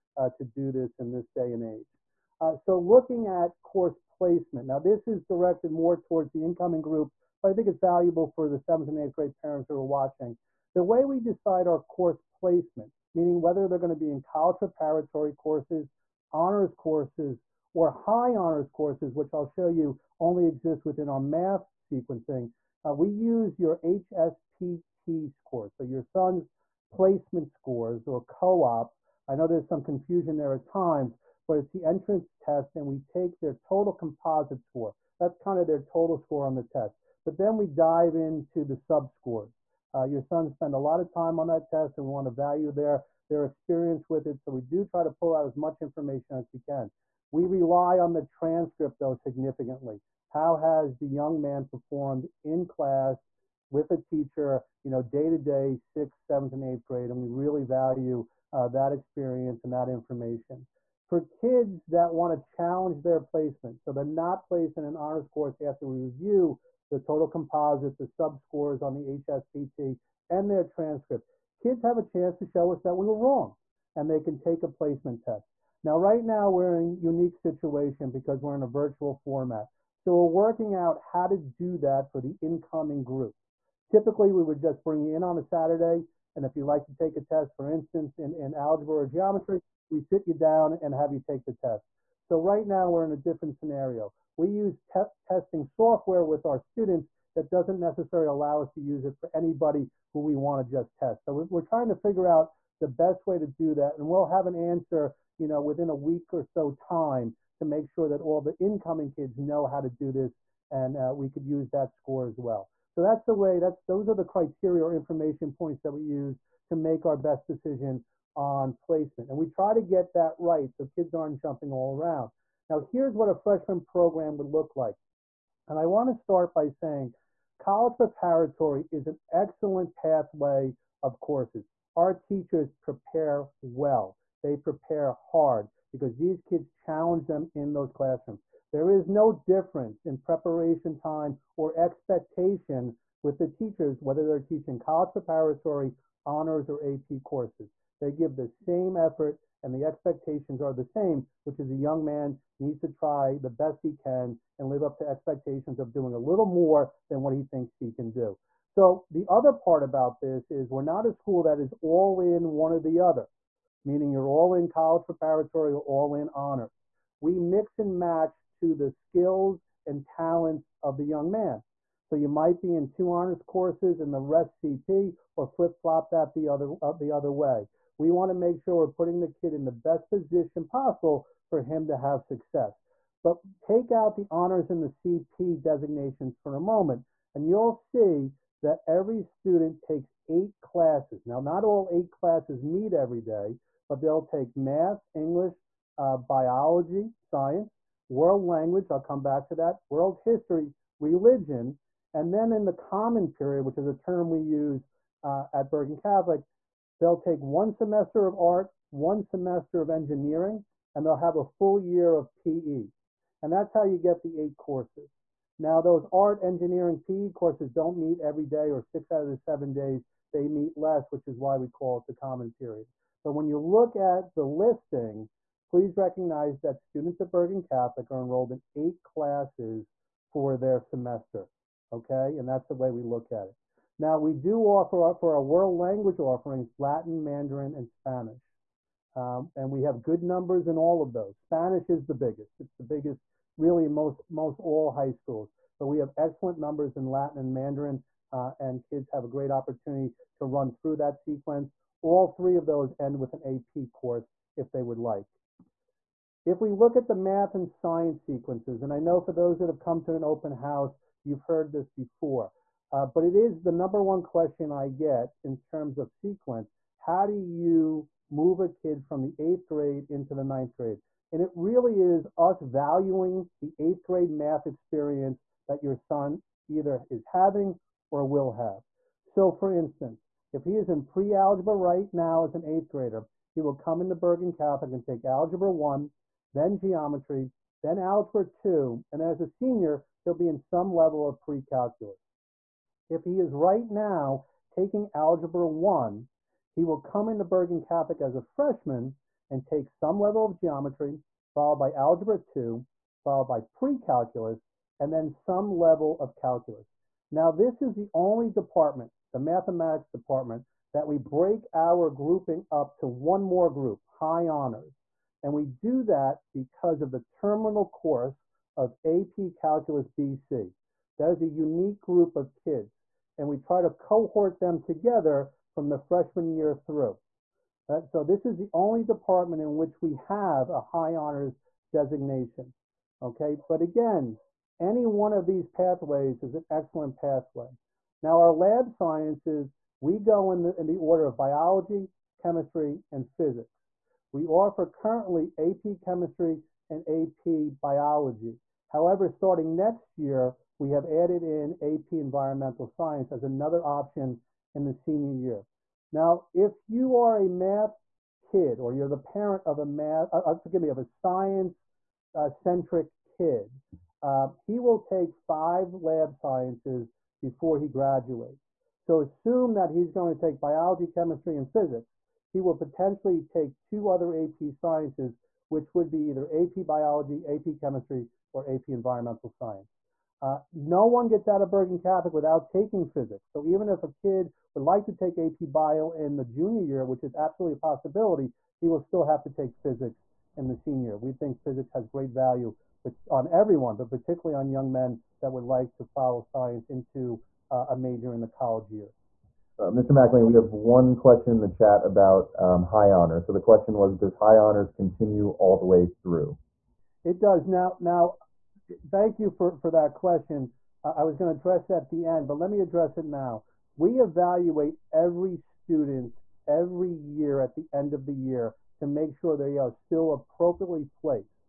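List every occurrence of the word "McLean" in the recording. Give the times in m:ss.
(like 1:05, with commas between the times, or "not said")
6:40.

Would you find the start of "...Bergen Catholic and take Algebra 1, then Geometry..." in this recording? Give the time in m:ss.
4:44.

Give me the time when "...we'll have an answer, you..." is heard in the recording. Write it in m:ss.
1:44.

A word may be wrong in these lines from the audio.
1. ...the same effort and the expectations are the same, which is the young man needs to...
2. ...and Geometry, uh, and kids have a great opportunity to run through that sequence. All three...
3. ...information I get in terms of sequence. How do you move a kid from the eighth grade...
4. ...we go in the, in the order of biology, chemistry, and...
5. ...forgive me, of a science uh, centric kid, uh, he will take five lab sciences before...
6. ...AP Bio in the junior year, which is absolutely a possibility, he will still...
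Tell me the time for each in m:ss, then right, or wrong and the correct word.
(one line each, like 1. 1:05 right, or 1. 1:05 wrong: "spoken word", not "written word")
1. 2:28 right
2. 4:07 wrong: "Mandarin", not "Geometry"
3. 4:24 wrong: "question", not "information"
4. 5:39 right
5. 6:00 right
6. 6:25 right.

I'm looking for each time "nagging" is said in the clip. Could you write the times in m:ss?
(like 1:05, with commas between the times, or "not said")
not said.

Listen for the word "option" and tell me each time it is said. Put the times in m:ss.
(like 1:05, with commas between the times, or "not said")
5:53.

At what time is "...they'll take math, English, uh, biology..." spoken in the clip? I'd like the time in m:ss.
3:14.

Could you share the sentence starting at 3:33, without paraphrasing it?
And that's how you get the eight courses.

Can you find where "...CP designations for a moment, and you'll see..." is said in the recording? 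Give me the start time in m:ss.
3:04.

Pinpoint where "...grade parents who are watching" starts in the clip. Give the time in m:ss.
0:09.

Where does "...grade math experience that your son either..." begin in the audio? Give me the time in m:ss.
4:34.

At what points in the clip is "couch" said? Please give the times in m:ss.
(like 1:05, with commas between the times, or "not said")
not said.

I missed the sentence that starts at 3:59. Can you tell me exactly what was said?
Um, and we have good numbers in all of those.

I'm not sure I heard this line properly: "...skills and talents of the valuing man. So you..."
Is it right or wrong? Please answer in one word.
wrong.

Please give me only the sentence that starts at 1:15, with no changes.
Now, right now, we're in a unique situation because we're in a virtual format.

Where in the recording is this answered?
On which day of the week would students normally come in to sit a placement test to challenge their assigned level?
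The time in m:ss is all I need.
1:25.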